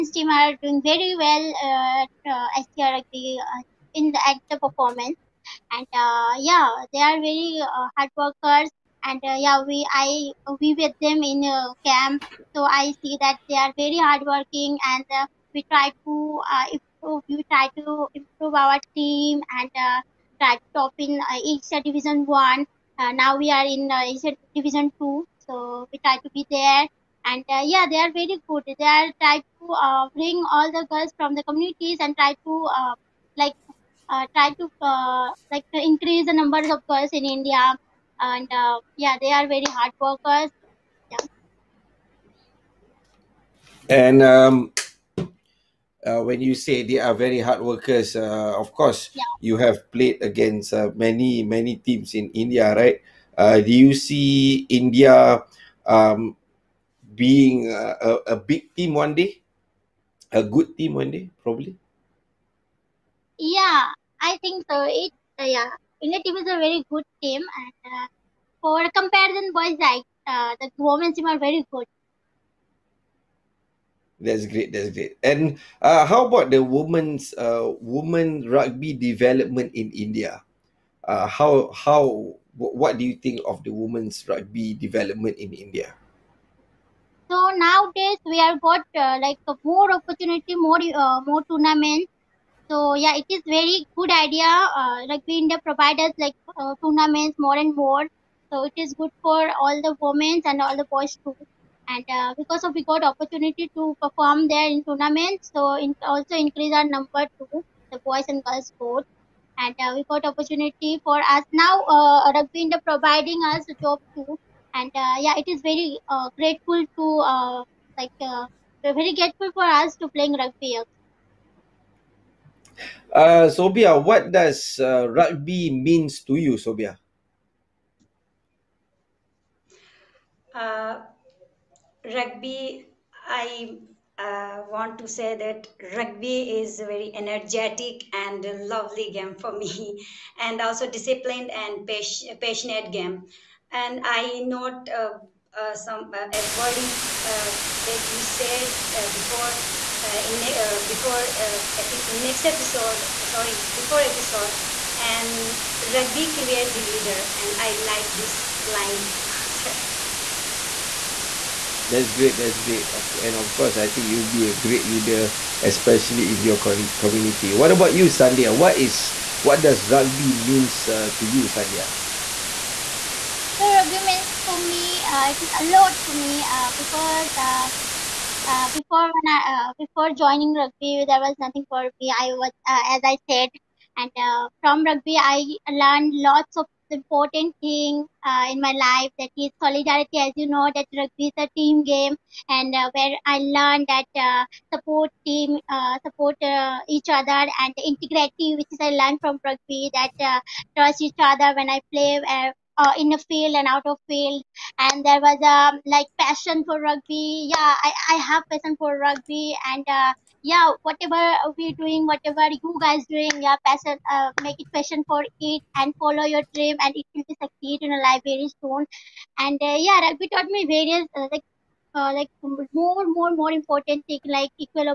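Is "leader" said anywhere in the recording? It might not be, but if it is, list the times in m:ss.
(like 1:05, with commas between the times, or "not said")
2:36, 2:44.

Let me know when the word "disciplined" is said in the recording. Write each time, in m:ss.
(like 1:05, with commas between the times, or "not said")
2:20.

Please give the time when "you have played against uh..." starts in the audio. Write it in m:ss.
0:49.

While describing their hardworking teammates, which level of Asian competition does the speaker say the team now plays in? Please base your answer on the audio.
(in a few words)
Asia Division Two.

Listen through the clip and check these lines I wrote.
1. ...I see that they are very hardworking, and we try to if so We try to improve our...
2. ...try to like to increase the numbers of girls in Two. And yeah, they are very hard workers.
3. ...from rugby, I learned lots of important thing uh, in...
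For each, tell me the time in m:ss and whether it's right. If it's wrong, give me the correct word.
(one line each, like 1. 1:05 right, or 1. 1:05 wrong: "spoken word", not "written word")
1. 0:12 right
2. 0:34 wrong: "India", not "Two"
3. 3:04 right.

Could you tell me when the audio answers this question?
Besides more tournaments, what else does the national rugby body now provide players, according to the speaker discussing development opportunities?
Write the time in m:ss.
1:53.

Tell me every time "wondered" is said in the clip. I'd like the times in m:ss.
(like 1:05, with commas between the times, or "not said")
not said.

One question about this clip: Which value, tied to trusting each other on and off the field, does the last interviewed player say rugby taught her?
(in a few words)
Integrity.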